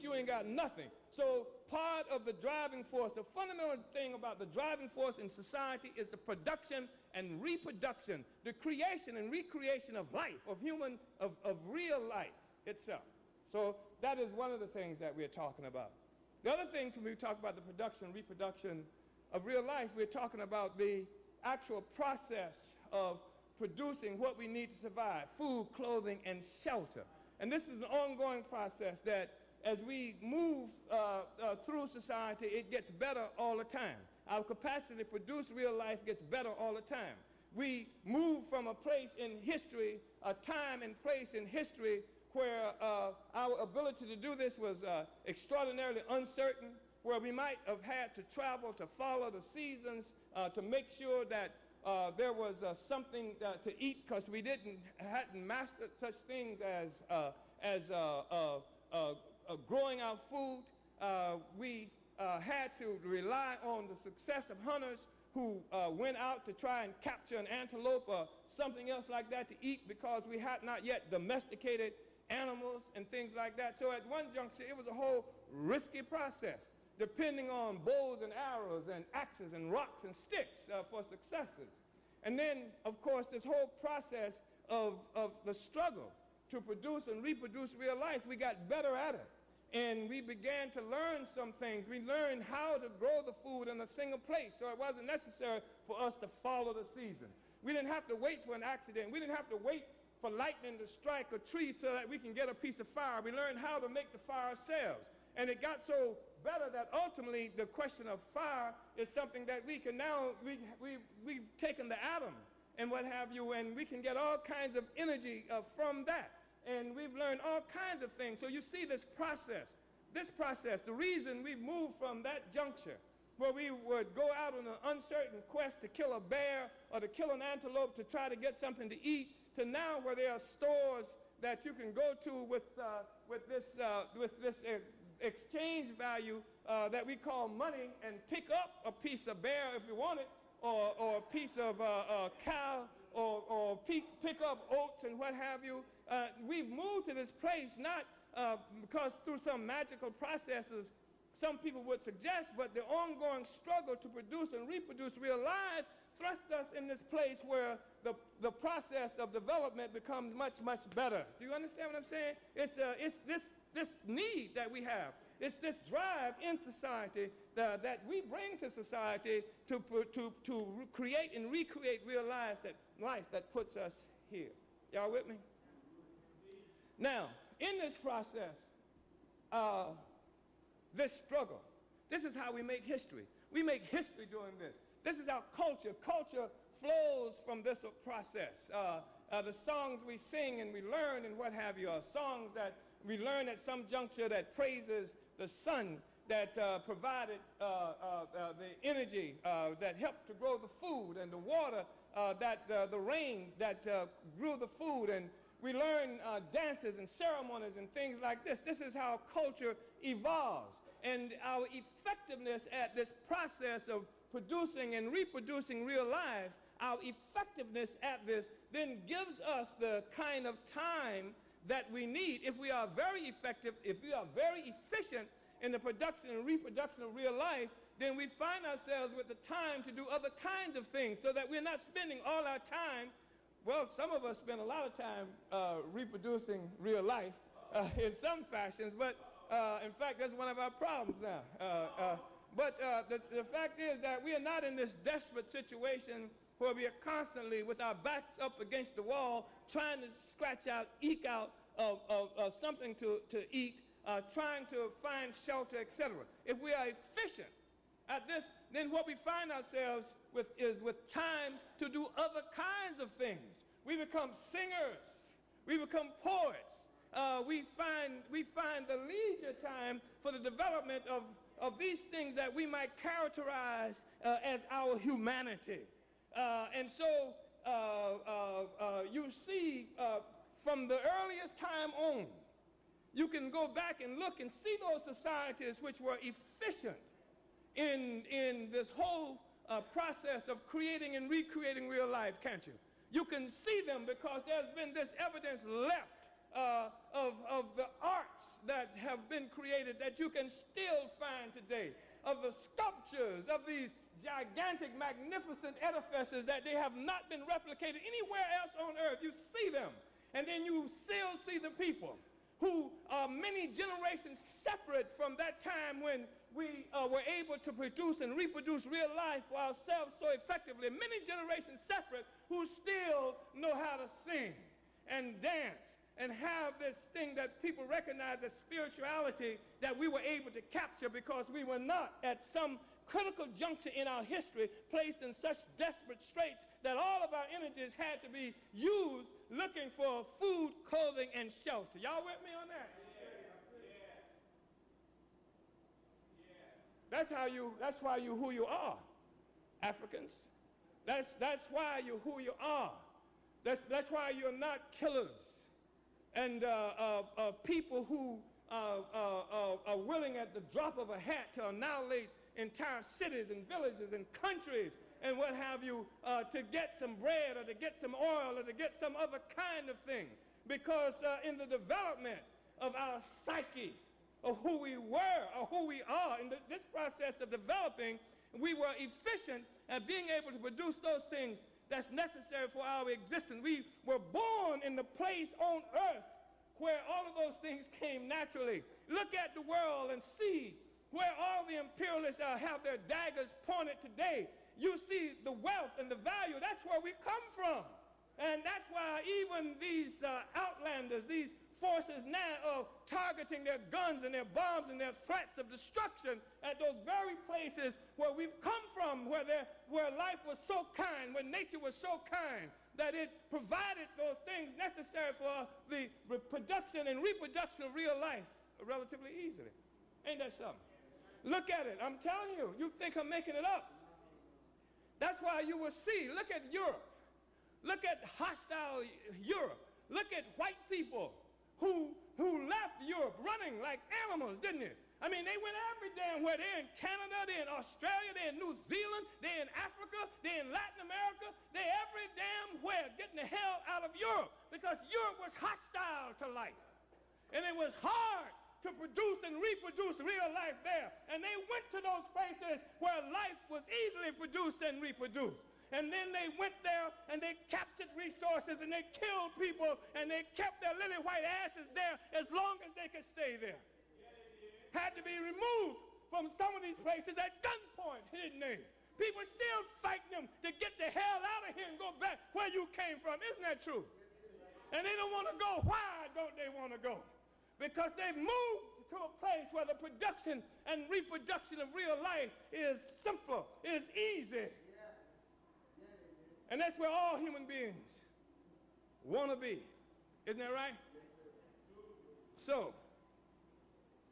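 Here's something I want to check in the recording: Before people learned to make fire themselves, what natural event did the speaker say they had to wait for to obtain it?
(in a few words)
lightning to strike a tree.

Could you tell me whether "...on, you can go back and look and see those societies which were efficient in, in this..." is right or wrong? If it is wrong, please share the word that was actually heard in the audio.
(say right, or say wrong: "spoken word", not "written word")
right.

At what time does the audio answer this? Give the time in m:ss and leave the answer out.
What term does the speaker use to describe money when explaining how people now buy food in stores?
2:15.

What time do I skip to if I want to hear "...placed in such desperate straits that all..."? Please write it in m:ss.
5:34.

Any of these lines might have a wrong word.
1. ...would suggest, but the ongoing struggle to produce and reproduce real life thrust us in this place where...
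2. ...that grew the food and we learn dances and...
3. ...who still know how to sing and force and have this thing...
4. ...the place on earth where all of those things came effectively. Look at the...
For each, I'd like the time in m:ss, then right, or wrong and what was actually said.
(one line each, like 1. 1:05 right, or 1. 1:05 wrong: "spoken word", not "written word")
1. 2:31 right
2. 3:23 right
3. 5:22 wrong: "dance", not "force"
4. 6:24 wrong: "naturally", not "effectively".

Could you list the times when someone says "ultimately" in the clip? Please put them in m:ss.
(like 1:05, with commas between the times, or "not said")
1:46.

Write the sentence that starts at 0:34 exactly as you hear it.
Our capacity to produce real life gets better all the time.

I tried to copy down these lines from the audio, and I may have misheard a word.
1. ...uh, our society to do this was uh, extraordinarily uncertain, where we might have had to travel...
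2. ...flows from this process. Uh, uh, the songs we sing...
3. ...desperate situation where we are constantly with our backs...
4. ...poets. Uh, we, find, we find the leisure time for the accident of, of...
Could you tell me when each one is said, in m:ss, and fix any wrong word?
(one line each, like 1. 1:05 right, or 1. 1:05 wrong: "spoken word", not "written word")
1. 0:42 wrong: "ability", not "society"
2. 3:06 right
3. 4:04 right
4. 4:26 wrong: "development", not "accident".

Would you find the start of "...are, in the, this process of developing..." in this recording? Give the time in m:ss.
6:16.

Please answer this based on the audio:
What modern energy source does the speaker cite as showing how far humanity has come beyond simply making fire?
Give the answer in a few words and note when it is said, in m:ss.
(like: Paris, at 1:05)
the atom, at 1:51.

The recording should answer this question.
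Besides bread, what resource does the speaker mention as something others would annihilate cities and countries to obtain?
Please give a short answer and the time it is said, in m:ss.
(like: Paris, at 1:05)
oil, at 6:08.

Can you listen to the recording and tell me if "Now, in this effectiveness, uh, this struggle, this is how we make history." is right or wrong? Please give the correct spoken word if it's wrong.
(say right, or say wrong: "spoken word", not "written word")
wrong: "process", not "effectiveness".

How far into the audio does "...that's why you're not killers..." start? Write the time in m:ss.
5:53.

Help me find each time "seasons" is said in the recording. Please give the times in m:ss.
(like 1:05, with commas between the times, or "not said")
0:49, 1:36.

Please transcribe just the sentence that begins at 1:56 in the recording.
And we've learned all kinds of things.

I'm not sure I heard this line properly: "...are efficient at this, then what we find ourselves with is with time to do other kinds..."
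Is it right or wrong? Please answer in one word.
right.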